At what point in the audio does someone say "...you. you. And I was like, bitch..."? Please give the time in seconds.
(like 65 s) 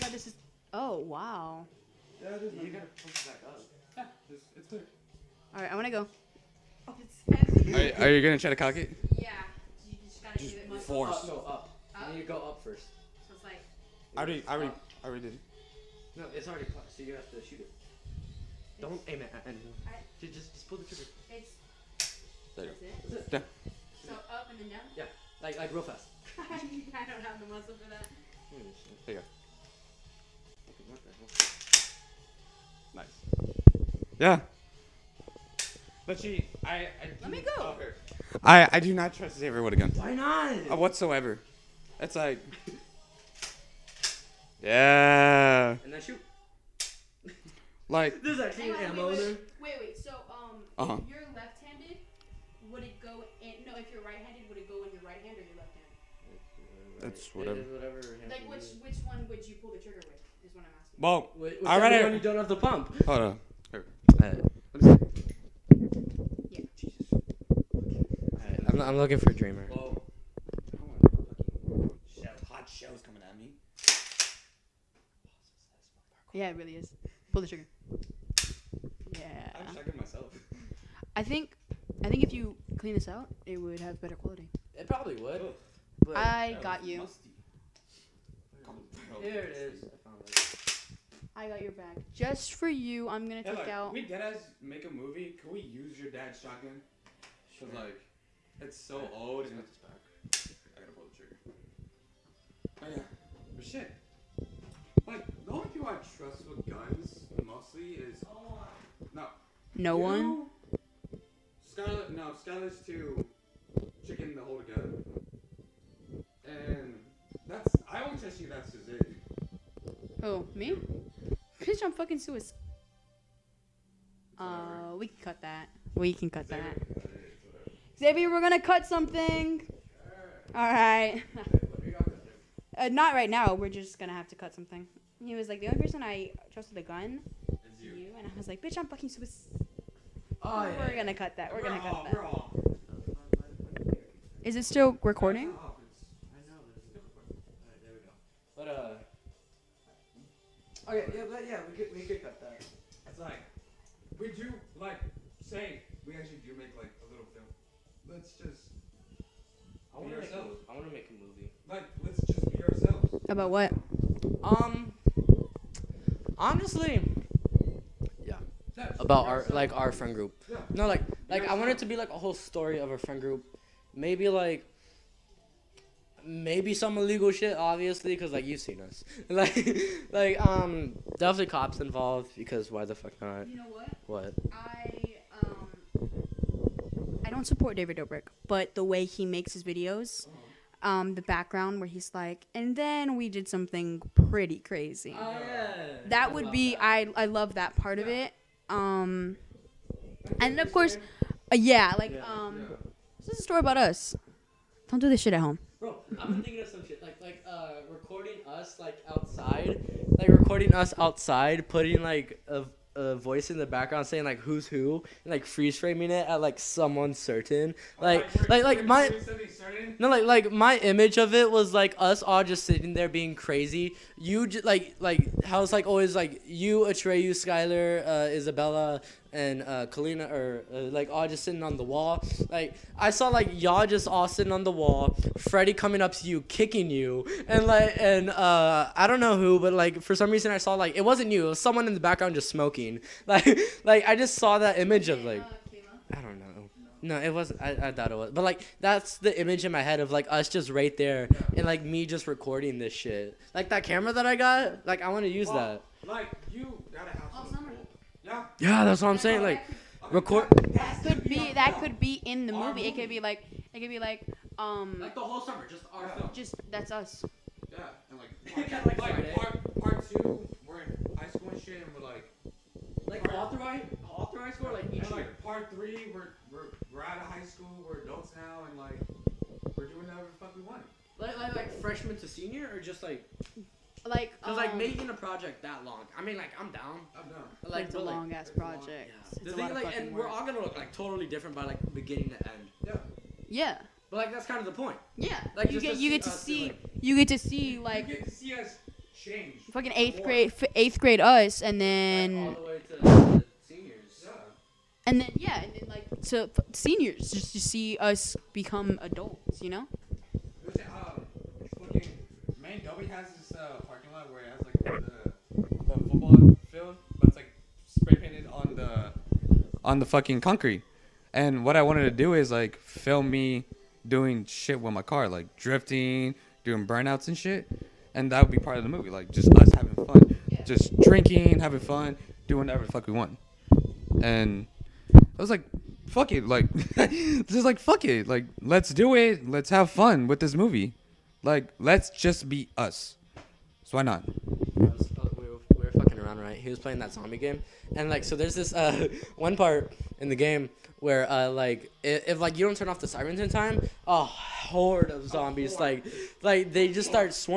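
137 s.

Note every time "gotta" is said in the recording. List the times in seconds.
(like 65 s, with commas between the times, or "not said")
2 s, 100 s.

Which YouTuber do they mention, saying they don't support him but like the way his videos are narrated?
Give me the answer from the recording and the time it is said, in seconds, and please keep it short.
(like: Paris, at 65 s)
David Dobrik, at 187 s.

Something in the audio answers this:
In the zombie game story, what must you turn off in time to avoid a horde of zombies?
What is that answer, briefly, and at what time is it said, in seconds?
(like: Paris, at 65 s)
the sirens, at 352 s.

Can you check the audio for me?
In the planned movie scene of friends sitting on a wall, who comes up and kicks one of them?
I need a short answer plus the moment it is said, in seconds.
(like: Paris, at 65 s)
Freddy, at 235 s.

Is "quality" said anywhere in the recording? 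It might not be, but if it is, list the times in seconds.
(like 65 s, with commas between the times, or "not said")
84 s.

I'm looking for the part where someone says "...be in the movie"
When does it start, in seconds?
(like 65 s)
261 s.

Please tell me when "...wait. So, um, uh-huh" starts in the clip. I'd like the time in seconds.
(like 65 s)
49 s.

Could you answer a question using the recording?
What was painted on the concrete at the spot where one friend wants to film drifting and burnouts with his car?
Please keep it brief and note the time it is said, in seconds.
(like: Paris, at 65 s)
the football field, at 315 s.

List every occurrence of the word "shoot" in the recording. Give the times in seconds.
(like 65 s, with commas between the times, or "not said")
17 s, 46 s.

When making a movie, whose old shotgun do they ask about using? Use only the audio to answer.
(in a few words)
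your dad's.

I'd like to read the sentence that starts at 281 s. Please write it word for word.
Like, like, like freshman to senior, or just like like, um, like making a project that long.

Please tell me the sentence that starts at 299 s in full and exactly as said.
Fucking eighth grade eighth grade us and then.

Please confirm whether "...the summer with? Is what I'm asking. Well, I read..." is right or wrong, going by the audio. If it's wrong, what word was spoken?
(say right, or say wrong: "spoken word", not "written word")
wrong: "trigger", not "summer".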